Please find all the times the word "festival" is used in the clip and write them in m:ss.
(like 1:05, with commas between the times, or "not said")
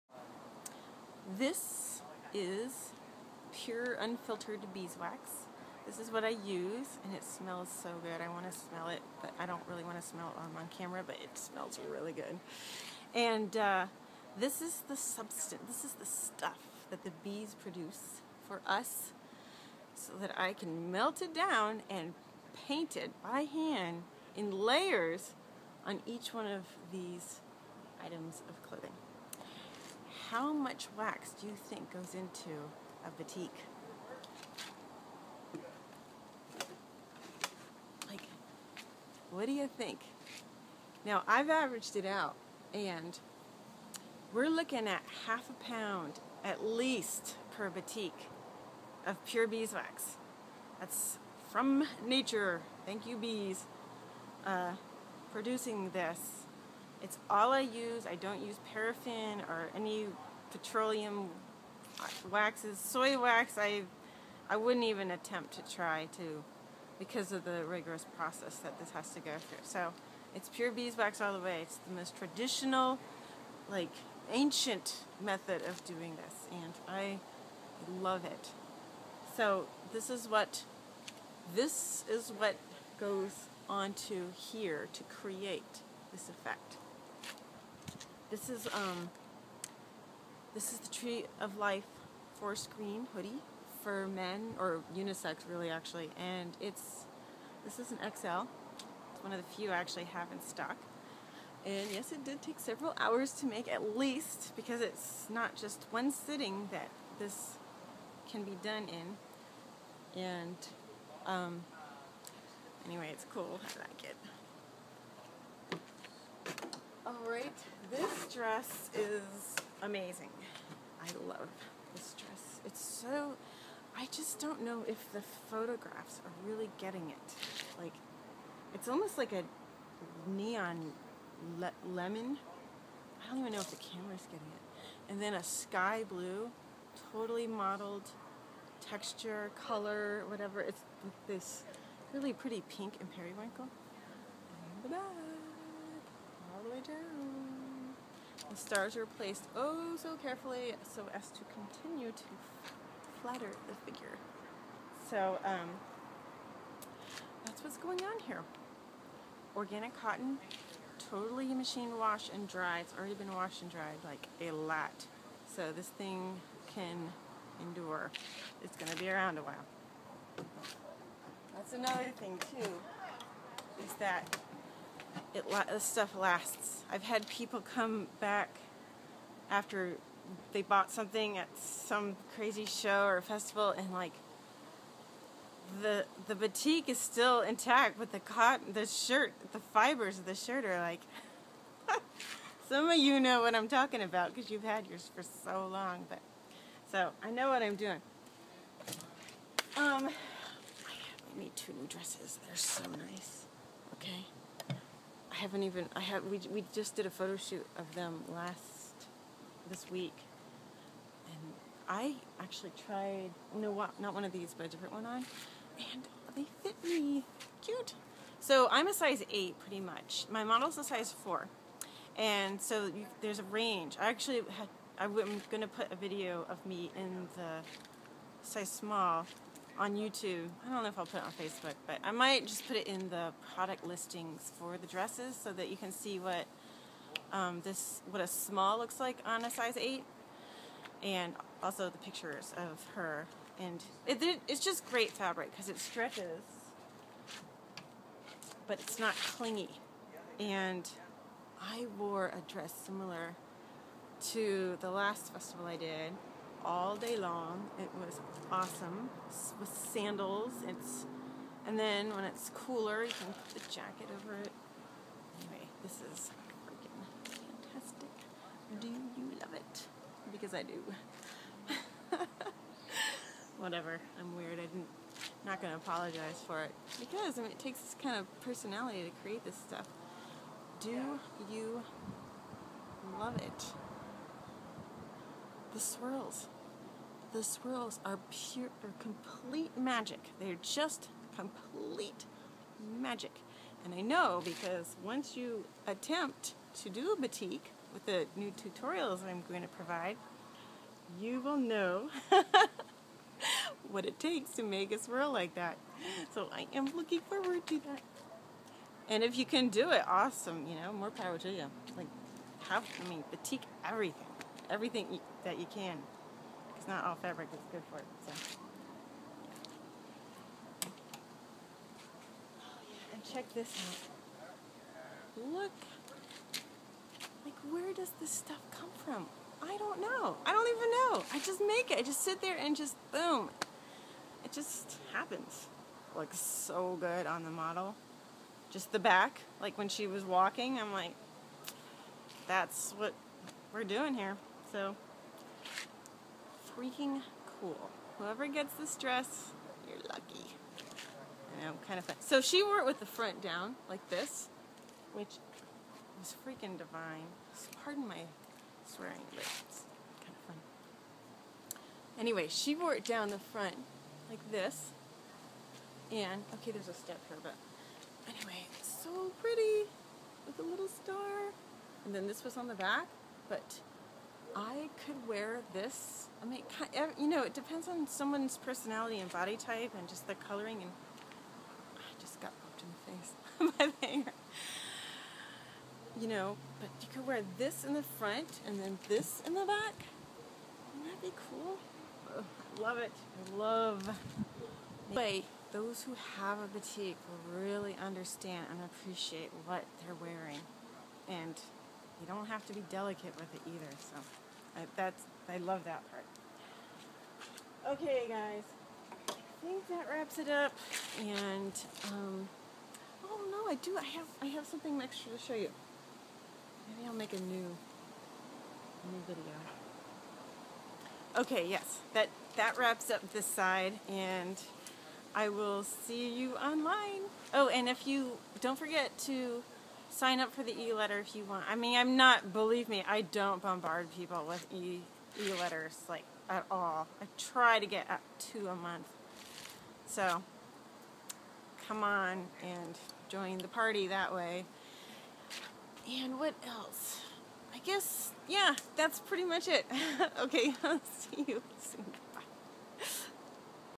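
3:03, 4:15.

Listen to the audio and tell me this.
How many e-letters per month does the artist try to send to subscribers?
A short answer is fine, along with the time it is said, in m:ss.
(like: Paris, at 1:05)
2, at 7:18.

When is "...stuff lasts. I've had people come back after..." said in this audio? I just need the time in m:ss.
2:55.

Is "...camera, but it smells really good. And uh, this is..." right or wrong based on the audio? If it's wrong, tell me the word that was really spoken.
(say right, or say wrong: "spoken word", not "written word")
right.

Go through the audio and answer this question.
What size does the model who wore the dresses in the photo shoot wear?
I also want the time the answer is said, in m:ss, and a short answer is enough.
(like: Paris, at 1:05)
4, at 3:40.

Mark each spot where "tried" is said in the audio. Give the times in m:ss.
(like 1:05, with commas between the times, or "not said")
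3:32.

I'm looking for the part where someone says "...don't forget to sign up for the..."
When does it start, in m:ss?
7:08.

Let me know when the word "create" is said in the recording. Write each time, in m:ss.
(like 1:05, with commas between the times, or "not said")
1:25, 4:39.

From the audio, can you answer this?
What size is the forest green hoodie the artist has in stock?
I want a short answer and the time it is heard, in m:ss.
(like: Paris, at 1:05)
XL, at 1:37.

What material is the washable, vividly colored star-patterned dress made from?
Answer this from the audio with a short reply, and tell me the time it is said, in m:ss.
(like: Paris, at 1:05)
Organic cotton, at 2:39.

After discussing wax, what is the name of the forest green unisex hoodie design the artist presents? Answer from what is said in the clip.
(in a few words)
Tree of Life.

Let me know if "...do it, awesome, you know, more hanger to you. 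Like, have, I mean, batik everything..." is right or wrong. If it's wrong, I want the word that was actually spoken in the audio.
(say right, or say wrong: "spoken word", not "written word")
wrong: "power", not "hanger".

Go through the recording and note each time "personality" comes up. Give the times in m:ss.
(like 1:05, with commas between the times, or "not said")
4:38, 6:18.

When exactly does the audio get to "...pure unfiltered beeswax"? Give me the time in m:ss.
0:03.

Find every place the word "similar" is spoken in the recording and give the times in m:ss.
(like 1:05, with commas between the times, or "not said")
4:12.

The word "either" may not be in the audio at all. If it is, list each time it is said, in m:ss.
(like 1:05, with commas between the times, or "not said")
6:43.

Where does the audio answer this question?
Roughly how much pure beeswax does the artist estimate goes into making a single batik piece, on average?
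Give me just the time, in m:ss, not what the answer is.
0:45.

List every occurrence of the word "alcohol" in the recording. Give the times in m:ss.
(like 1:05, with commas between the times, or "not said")
not said.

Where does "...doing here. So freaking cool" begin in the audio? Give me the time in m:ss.
5:43.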